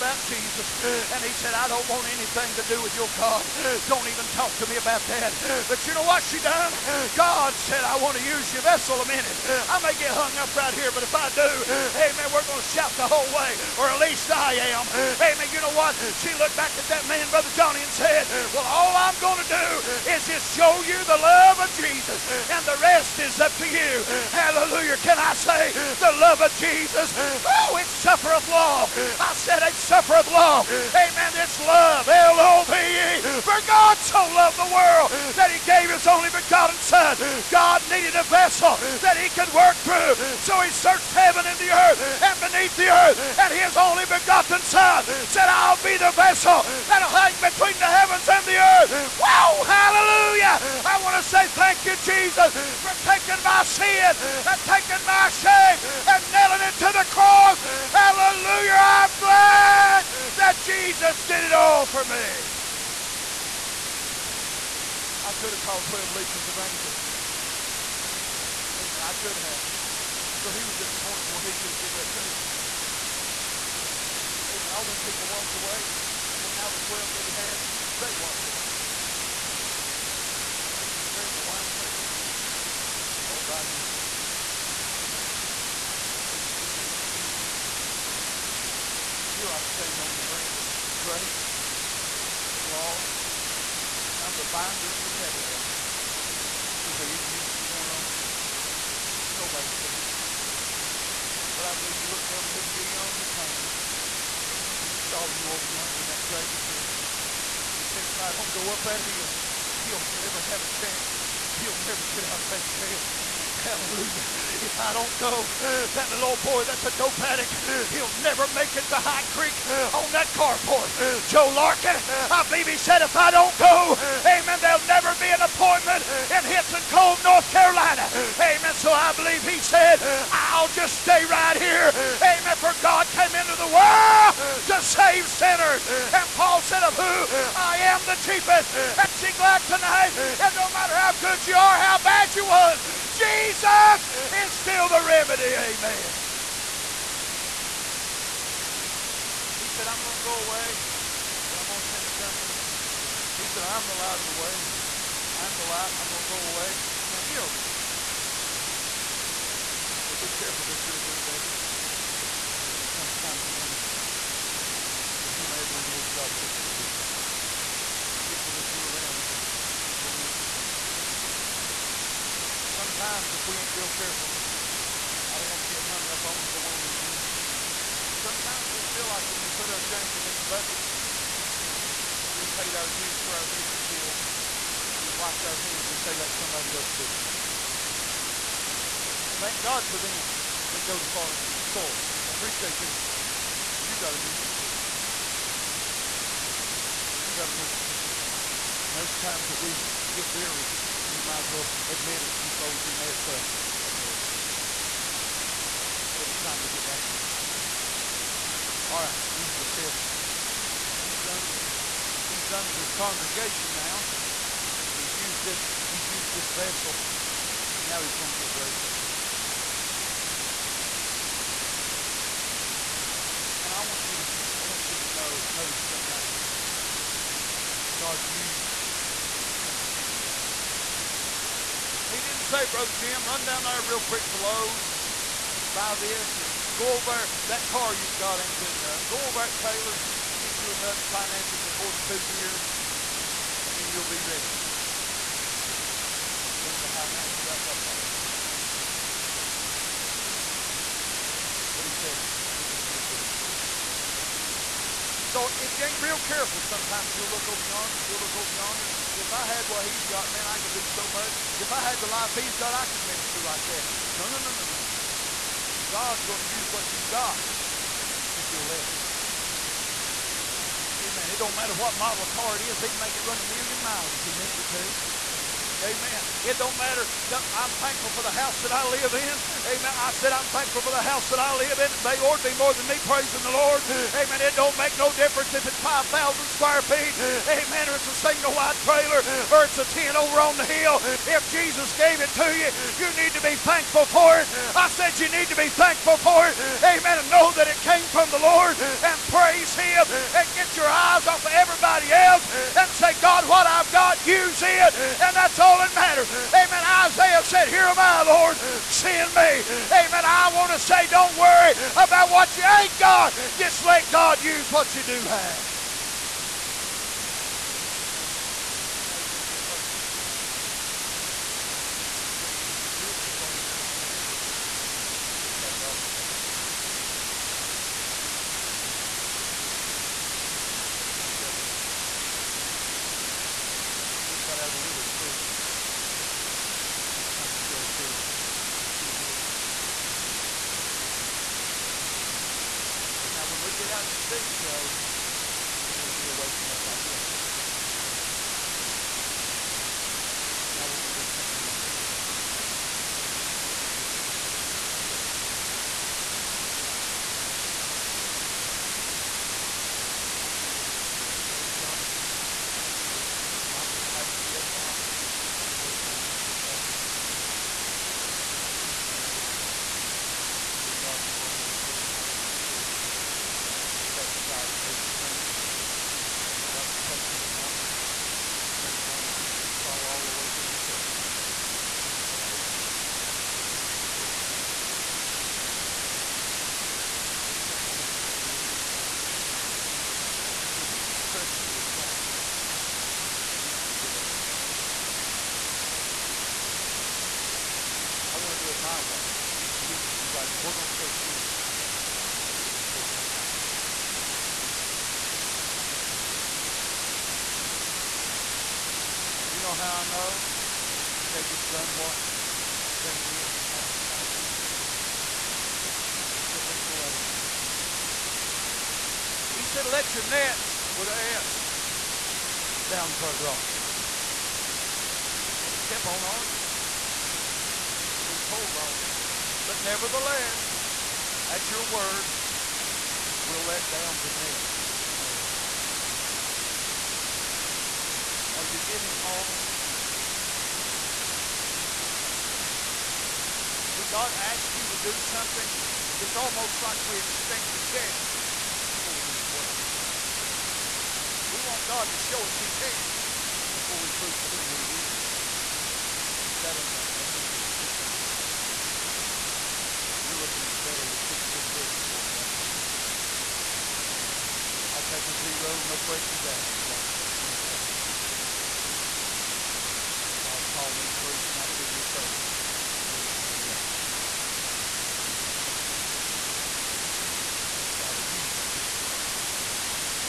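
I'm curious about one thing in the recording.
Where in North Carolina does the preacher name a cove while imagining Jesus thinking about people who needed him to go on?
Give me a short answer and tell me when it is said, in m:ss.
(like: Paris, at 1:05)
Hitson Cove, at 2:06.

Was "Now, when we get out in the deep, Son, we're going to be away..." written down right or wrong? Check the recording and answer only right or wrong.
wrong.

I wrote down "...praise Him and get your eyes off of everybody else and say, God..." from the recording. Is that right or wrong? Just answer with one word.
right.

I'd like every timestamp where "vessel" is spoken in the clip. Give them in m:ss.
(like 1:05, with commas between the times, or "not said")
0:08, 0:38, 0:46, 2:41, 3:36, 6:34.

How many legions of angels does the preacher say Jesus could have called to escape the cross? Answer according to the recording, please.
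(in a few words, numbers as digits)
12.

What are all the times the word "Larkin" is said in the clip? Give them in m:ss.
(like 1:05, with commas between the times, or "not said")
2:01.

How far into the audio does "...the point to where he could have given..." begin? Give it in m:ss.
1:10.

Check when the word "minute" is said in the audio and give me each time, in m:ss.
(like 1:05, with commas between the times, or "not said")
0:09, 2:56.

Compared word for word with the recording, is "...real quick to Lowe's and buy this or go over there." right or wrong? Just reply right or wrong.
right.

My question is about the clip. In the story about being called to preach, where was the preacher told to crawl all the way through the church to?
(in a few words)
the front.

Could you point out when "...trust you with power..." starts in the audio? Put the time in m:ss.
6:31.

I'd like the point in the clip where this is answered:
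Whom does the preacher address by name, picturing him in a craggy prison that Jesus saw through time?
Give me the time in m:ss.
1:43.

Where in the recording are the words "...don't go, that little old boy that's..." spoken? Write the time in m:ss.
1:54.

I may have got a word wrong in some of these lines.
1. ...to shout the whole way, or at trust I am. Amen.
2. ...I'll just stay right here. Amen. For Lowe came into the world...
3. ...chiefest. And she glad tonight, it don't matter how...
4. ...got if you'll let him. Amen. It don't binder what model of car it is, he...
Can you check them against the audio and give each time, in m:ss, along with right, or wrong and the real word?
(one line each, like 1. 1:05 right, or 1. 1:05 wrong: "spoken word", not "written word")
1. 0:12 wrong: "least", not "trust"
2. 2:10 wrong: "God", not "Lowe"
3. 2:18 right
4. 4:27 wrong: "matter", not "binder".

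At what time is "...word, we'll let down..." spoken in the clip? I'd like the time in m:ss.
7:11.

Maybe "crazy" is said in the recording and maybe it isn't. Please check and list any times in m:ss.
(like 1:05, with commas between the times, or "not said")
7:52.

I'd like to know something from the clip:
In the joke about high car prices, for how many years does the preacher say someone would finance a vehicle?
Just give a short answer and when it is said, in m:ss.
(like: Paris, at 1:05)
42, at 4:01.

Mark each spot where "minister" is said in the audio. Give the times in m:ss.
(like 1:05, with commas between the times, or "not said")
2:43, 4:23.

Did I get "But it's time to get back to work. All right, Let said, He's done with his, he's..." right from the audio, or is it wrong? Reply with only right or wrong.
wrong.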